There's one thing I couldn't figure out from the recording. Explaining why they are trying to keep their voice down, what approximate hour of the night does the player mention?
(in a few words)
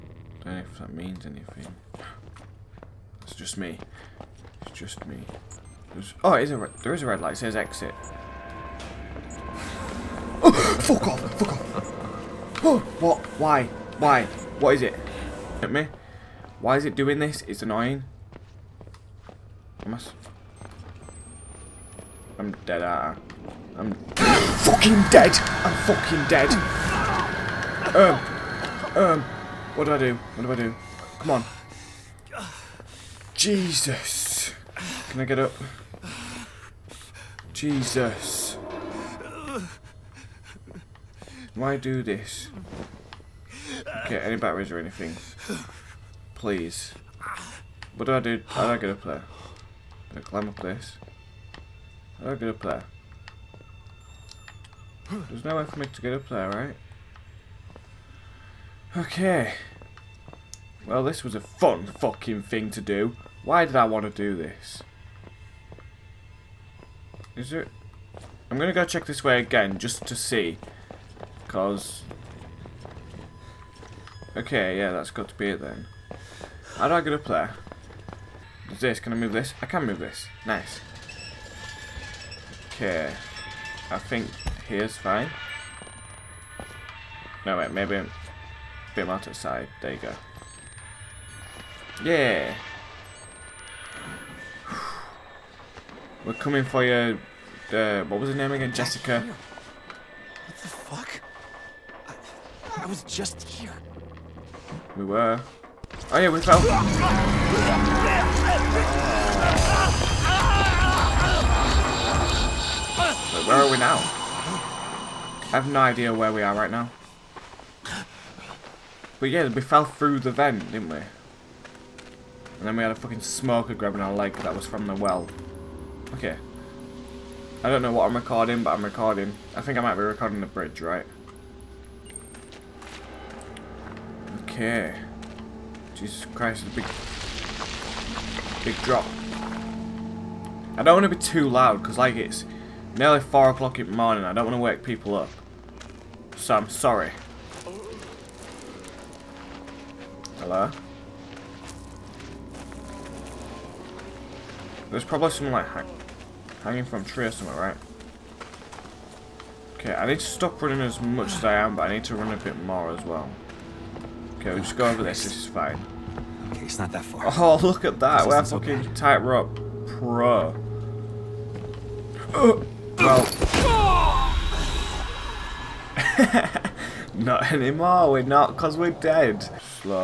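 4 o'clock.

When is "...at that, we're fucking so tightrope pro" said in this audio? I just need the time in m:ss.
2:47.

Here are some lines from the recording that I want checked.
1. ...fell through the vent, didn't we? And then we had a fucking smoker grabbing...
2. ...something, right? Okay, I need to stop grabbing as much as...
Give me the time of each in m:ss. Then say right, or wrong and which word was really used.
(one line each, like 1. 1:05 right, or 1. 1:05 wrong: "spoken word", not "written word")
1. 1:59 right
2. 2:37 wrong: "running", not "grabbing".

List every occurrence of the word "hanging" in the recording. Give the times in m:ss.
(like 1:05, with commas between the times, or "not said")
2:36.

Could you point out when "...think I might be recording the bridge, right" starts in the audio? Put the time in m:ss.
2:09.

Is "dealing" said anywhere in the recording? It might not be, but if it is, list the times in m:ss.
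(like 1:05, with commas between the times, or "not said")
not said.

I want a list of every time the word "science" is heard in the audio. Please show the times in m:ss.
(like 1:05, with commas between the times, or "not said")
not said.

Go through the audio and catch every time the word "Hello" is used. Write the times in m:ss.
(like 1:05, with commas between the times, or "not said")
2:30.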